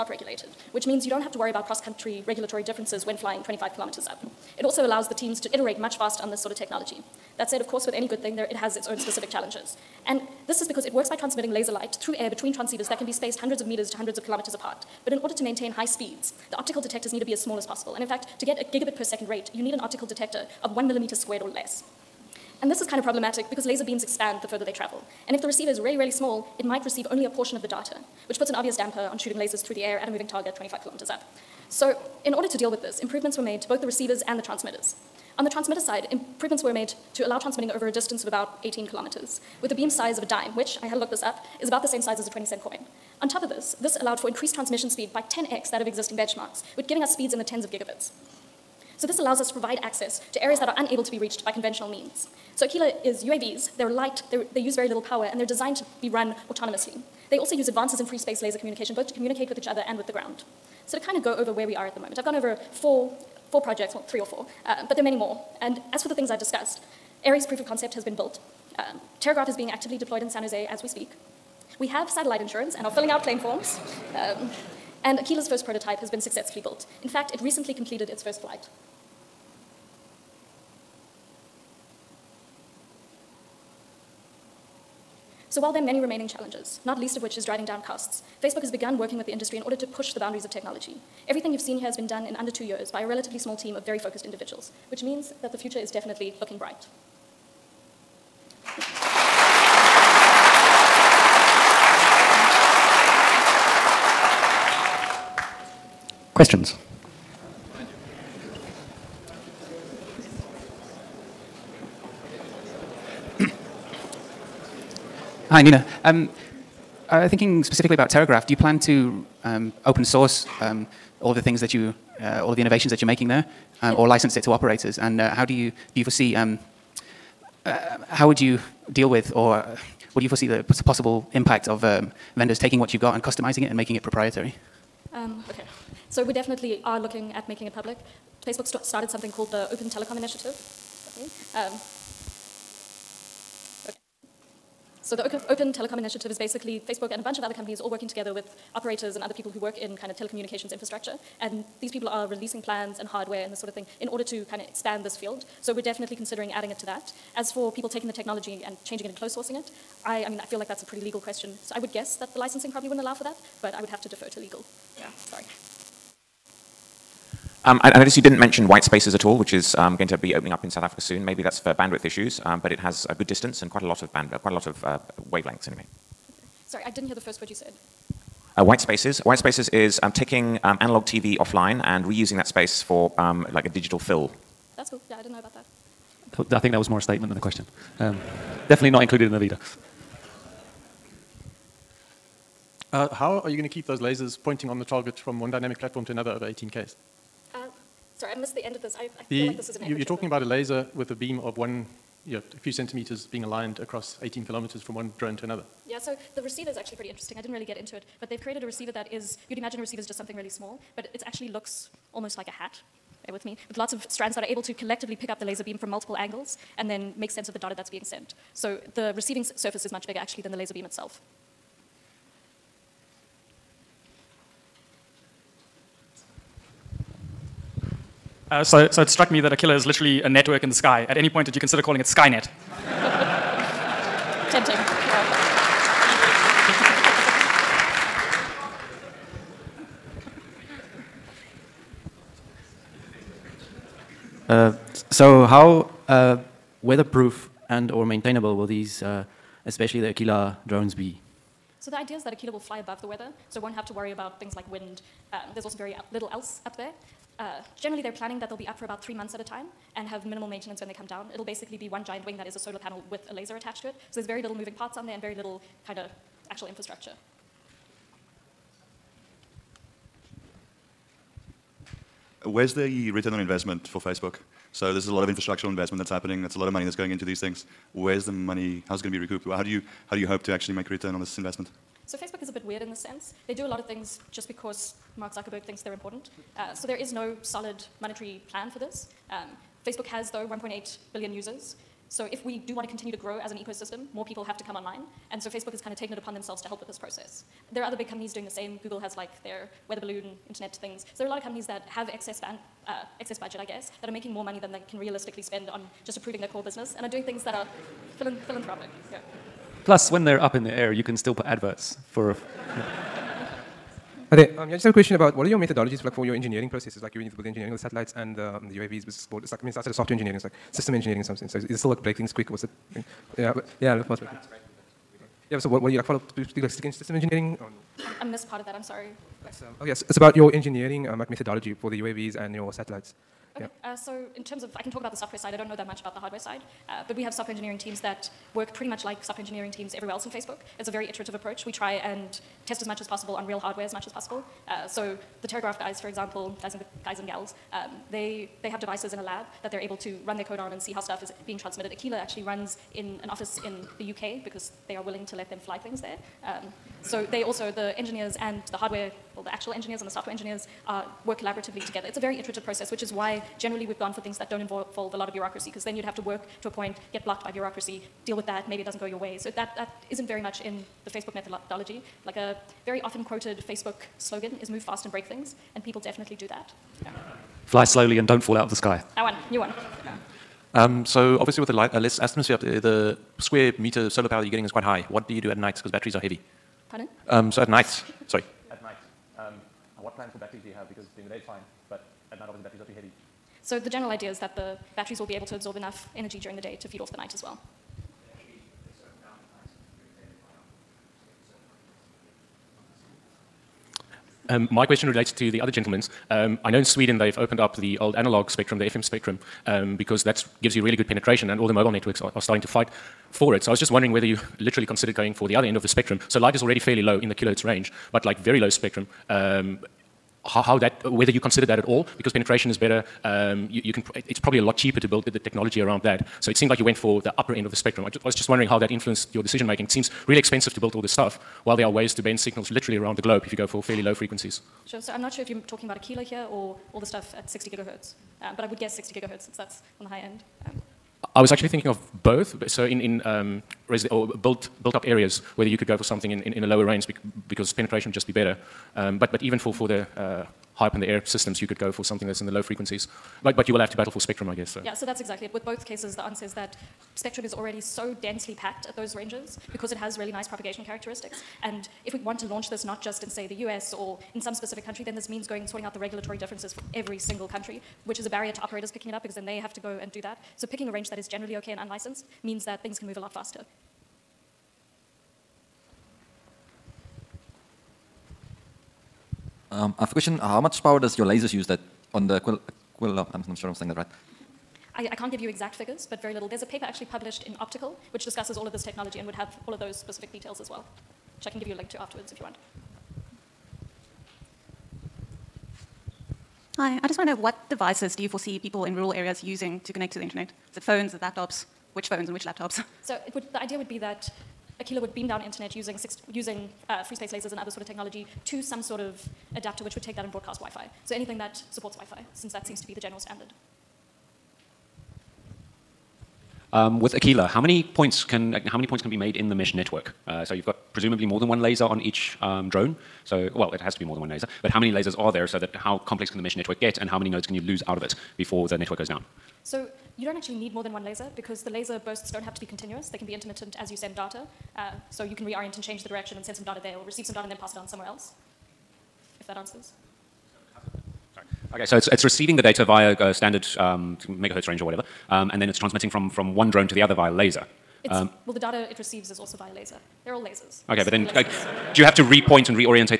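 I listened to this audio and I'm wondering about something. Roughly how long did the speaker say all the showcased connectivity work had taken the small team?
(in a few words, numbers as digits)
Under two years.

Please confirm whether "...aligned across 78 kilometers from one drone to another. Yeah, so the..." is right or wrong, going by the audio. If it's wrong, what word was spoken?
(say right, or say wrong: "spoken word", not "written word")
wrong: "18", not "78".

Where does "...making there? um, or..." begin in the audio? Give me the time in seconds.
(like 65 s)
123 s.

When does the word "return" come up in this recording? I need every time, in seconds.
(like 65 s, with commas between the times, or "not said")
273 s, 280 s.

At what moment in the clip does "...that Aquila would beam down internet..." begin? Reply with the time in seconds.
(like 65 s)
503 s.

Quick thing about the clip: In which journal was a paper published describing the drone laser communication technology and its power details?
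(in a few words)
Optica.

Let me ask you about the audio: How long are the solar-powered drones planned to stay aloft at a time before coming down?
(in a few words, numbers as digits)
About three months.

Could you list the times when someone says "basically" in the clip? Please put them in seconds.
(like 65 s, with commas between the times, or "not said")
146 s, 261 s.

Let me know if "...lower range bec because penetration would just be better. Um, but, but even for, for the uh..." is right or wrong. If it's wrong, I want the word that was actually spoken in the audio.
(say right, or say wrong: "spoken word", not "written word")
right.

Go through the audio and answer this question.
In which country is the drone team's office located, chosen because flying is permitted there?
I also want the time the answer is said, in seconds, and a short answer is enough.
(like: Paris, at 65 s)
The UK, at 354 s.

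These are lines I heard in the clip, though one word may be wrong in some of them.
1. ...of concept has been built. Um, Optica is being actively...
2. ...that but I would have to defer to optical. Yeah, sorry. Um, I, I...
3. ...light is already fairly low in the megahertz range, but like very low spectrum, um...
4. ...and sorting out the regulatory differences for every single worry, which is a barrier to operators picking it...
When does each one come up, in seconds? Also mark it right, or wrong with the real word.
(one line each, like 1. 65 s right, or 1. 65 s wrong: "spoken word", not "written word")
1. 67 s wrong: "Terragraph", not "Optica"
2. 163 s wrong: "legal", not "optical"
3. 416 s wrong: "kilohertz", not "megahertz"
4. 465 s wrong: "country", not "worry".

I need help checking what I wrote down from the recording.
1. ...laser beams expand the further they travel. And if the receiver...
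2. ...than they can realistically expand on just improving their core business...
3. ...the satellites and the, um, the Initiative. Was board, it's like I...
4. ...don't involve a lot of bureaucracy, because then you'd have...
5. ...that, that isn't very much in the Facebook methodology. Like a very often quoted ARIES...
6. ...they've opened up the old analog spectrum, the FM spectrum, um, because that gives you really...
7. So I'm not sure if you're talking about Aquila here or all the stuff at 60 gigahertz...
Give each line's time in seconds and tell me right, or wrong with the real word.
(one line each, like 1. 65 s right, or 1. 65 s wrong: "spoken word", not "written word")
1. 23 s right
2. 304 s wrong: "spend", not "expand"
3. 317 s wrong: "UAVs", not "Initiative"
4. 364 s right
5. 369 s wrong: "Facebook", not "ARIES"
6. 407 s right
7. 435 s right.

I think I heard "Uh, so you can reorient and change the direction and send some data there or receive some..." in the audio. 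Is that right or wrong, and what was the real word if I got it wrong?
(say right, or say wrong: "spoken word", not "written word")
right.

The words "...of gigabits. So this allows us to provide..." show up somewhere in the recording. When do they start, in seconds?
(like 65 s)
47 s.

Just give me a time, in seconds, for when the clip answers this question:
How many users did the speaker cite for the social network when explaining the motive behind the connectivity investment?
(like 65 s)
290 s.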